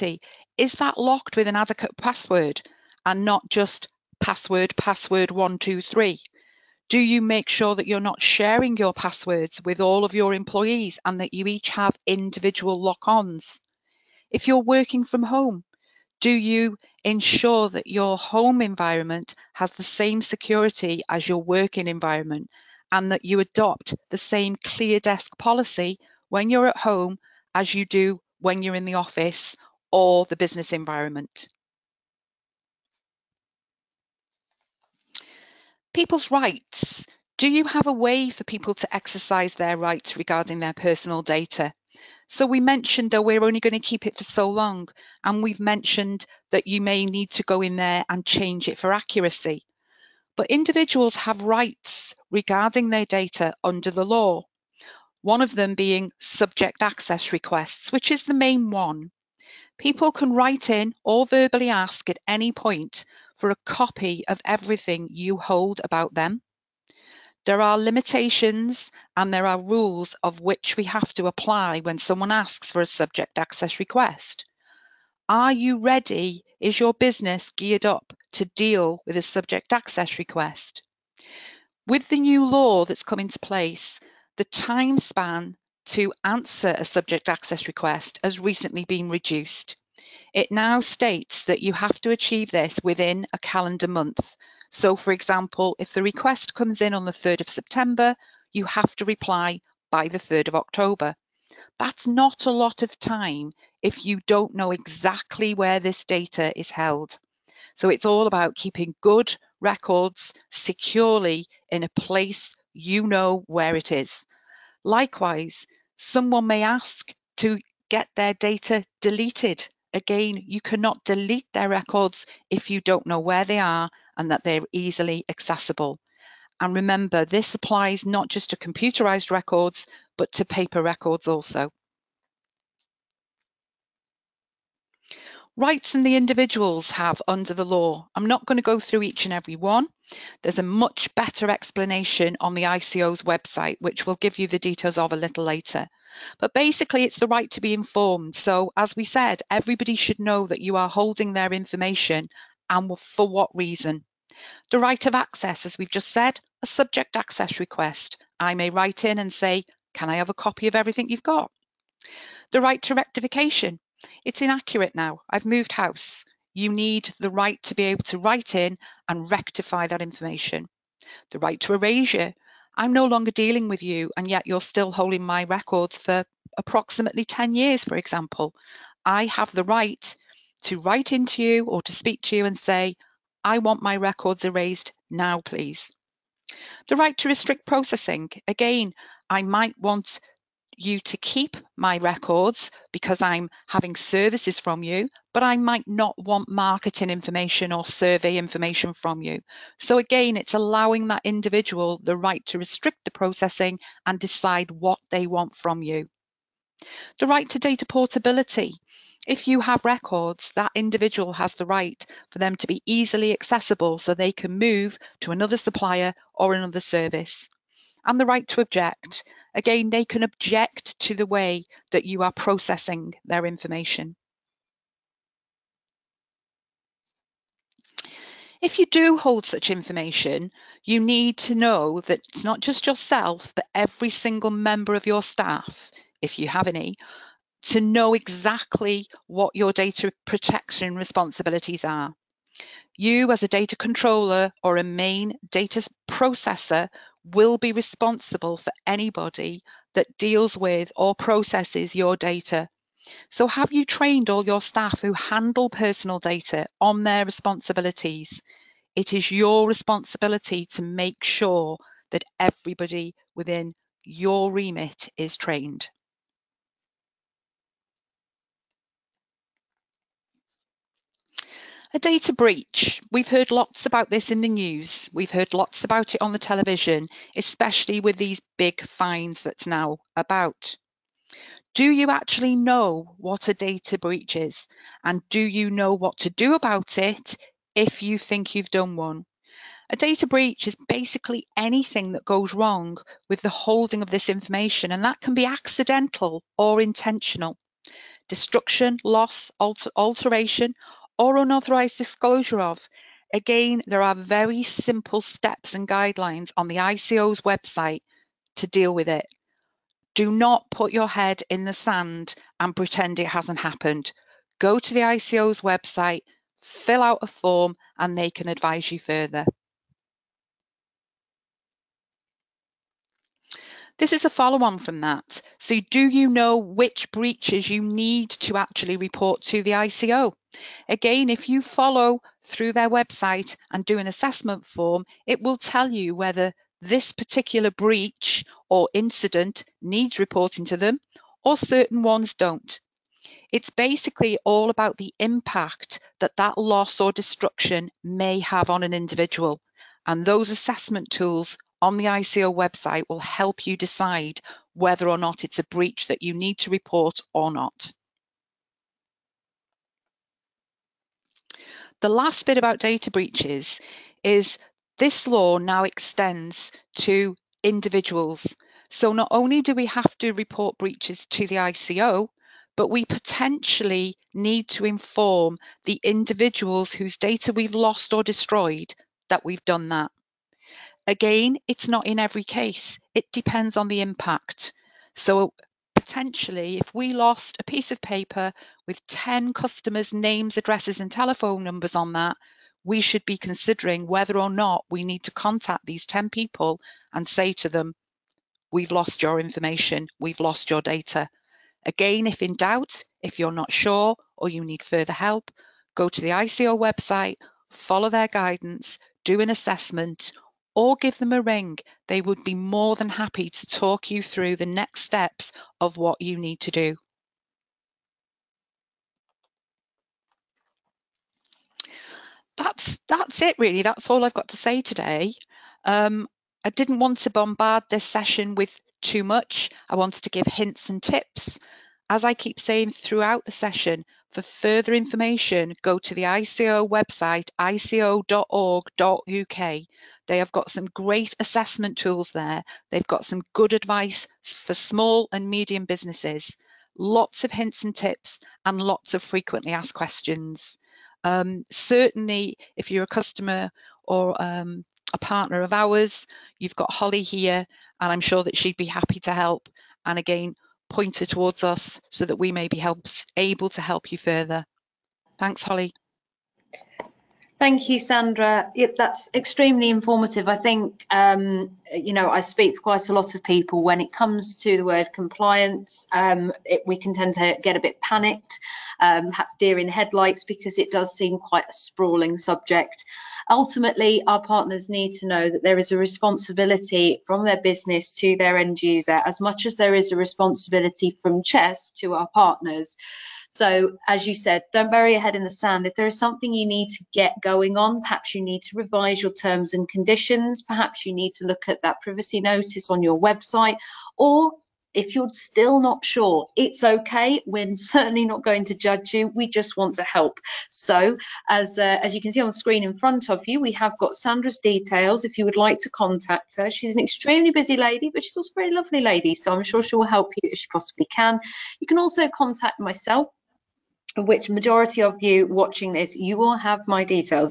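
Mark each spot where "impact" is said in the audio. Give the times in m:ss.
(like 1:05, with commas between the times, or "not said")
5:45, 6:24.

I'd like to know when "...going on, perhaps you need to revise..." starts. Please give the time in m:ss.
8:17.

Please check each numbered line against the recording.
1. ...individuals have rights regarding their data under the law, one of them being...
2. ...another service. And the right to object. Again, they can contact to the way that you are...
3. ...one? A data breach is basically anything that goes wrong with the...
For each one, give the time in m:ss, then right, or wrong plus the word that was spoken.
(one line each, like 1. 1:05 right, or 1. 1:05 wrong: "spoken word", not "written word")
1. 0:50 right
2. 3:36 wrong: "object", not "contact"
3. 4:48 right.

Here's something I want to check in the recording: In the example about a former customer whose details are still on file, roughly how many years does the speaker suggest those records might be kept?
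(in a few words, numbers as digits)
10 years.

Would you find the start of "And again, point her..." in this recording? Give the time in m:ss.
7:40.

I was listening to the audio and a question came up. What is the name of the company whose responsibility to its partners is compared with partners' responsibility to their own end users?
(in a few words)
Chess.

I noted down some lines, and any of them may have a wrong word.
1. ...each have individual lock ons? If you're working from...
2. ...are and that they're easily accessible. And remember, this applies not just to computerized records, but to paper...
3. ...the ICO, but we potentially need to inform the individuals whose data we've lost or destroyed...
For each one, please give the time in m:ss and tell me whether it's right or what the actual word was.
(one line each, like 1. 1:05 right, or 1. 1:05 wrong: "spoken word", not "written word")
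1. 0:11 right
2. 2:03 right
3. 6:11 right.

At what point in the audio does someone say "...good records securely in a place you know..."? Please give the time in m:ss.
1:49.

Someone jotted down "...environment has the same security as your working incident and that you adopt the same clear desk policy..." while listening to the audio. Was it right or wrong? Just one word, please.
wrong.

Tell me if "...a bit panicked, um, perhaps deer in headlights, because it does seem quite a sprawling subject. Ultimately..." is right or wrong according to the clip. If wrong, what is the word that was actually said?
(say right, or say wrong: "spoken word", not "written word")
right.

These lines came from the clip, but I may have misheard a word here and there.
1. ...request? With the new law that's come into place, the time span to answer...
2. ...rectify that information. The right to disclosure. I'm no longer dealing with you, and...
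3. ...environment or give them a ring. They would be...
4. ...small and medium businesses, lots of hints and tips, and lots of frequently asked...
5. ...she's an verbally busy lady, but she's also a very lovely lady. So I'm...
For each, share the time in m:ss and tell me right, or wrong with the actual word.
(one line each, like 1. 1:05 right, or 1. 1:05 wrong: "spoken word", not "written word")
1. 1:20 right
2. 2:49 wrong: "erasure", not "disclosure"
3. 6:49 wrong: "assessment", not "environment"
4. 7:24 right
5. 8:36 wrong: "extremely", not "verbally".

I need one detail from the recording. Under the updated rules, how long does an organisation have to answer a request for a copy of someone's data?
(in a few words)
a calendar month.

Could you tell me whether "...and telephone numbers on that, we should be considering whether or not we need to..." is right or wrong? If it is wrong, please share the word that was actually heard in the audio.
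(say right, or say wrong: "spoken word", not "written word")
right.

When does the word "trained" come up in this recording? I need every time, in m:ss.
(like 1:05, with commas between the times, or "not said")
4:13, 4:25.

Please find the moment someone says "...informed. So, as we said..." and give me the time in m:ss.
2:27.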